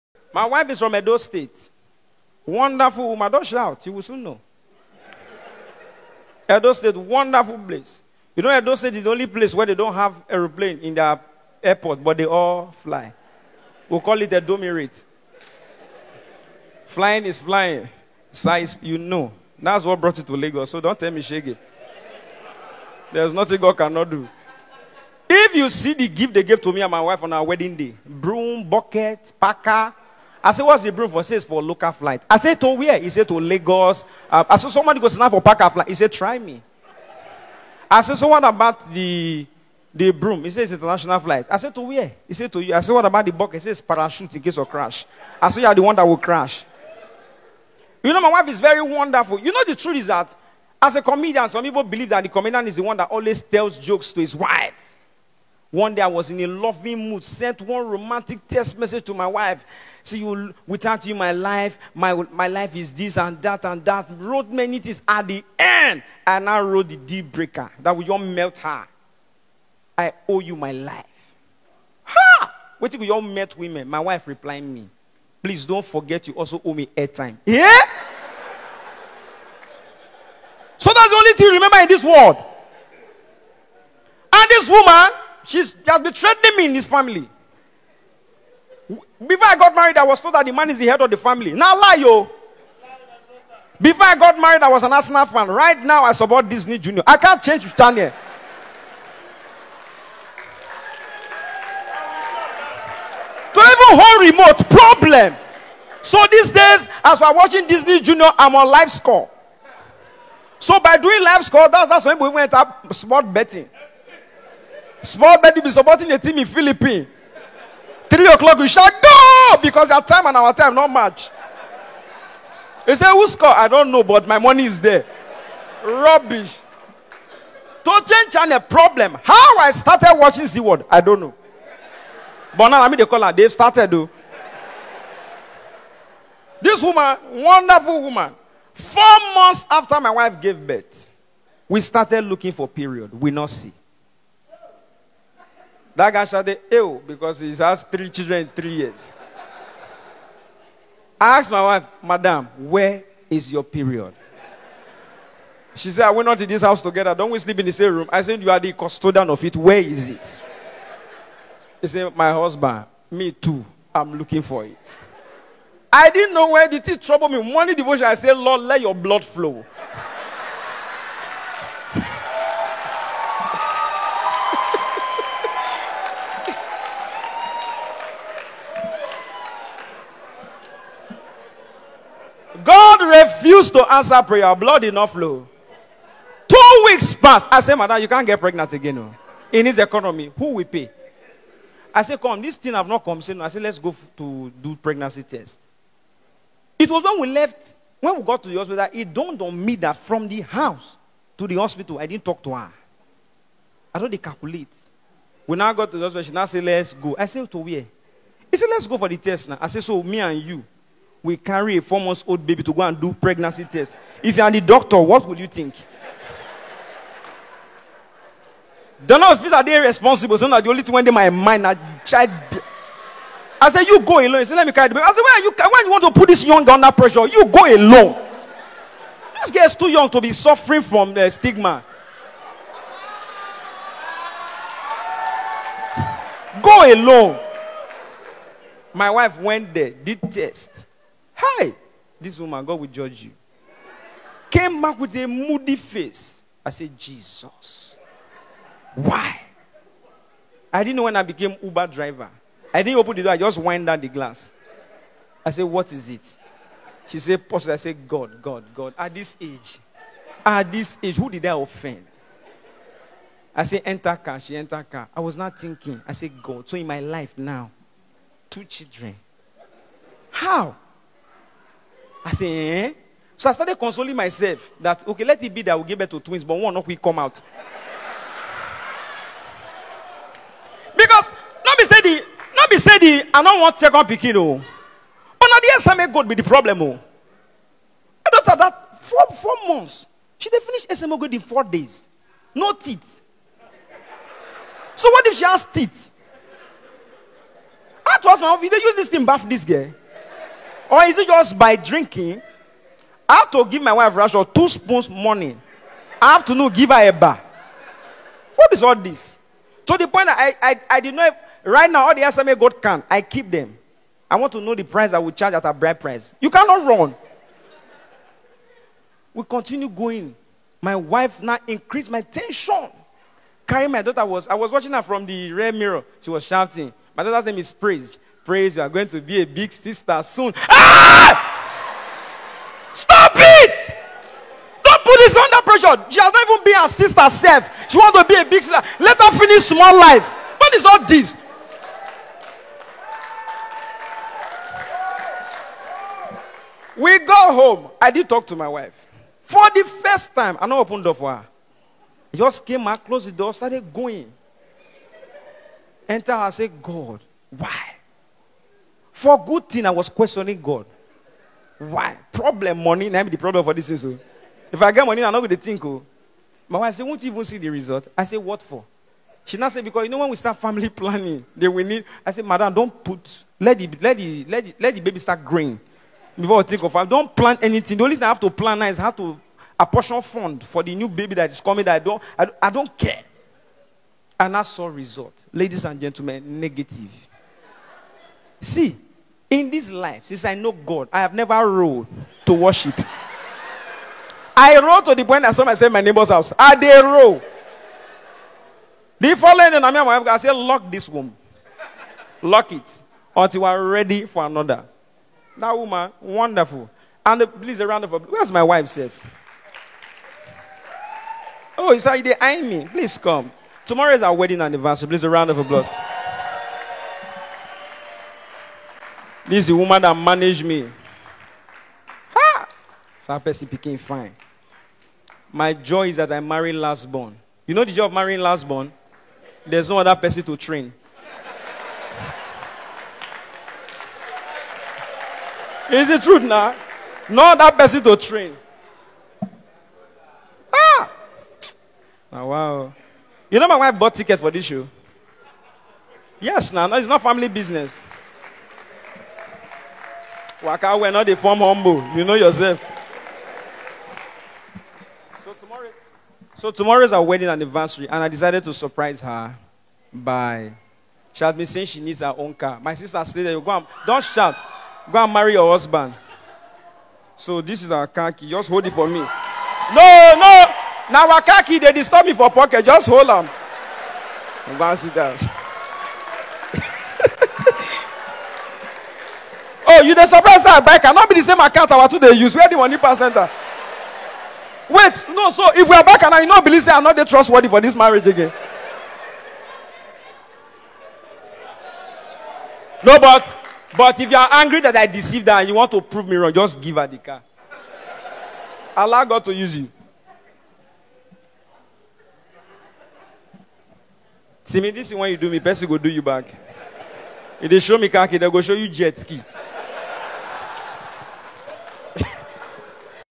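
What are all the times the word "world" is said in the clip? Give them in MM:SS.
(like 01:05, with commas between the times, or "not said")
01:22, 02:10.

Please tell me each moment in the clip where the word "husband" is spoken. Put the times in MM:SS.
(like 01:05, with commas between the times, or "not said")
02:42, 07:45.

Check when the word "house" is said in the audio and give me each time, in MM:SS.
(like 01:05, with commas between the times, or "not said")
02:36, 03:20, 06:36.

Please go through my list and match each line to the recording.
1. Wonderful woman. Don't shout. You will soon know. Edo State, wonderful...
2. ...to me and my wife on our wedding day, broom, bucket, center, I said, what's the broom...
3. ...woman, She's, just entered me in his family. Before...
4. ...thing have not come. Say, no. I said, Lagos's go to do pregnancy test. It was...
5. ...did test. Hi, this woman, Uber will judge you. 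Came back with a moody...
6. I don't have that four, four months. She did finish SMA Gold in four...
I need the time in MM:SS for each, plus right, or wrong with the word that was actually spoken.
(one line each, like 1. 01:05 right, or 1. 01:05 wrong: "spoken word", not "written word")
1. 00:02 right
2. 00:26 wrong: "packer", not "center"
3. 01:24 wrong: "betrayed", not "entered"
4. 03:12 wrong: "Let", not "Lagos"
5. 03:59 wrong: "God", not "Uber"
6. 04:48 right.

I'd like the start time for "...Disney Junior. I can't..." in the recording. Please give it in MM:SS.
01:36.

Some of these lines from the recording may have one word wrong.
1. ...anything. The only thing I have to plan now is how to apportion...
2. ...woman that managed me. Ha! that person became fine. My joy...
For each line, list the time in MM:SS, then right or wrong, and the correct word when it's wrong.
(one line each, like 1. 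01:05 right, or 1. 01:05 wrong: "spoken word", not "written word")
1. 06:17 right
2. 06:59 right.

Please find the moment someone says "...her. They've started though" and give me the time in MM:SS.
02:13.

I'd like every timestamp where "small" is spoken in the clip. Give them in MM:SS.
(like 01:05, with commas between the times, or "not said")
01:55, 05:39.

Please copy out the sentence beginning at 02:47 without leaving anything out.
Morning devotion, I said, Lord, let your blood flow.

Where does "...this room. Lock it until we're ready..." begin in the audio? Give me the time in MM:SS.
06:40.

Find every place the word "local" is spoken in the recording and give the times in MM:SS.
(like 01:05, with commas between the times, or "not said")
00:31.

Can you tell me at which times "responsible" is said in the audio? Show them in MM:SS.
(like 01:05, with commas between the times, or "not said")
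03:39.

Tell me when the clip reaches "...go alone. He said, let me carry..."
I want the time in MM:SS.
03:44.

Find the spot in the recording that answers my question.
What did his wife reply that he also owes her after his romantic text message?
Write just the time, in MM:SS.
01:16.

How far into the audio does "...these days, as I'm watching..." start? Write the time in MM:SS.
01:46.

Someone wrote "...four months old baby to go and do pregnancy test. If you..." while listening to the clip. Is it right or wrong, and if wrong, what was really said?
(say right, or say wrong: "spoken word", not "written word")
right.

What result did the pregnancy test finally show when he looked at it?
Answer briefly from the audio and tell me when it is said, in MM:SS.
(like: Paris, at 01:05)
negative, at 06:26.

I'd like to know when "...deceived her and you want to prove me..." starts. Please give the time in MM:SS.
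08:15.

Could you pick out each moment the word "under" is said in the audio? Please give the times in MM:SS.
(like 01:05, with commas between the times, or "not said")
03:46, 05:35.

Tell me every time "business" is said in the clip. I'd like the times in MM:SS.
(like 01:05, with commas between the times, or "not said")
07:27.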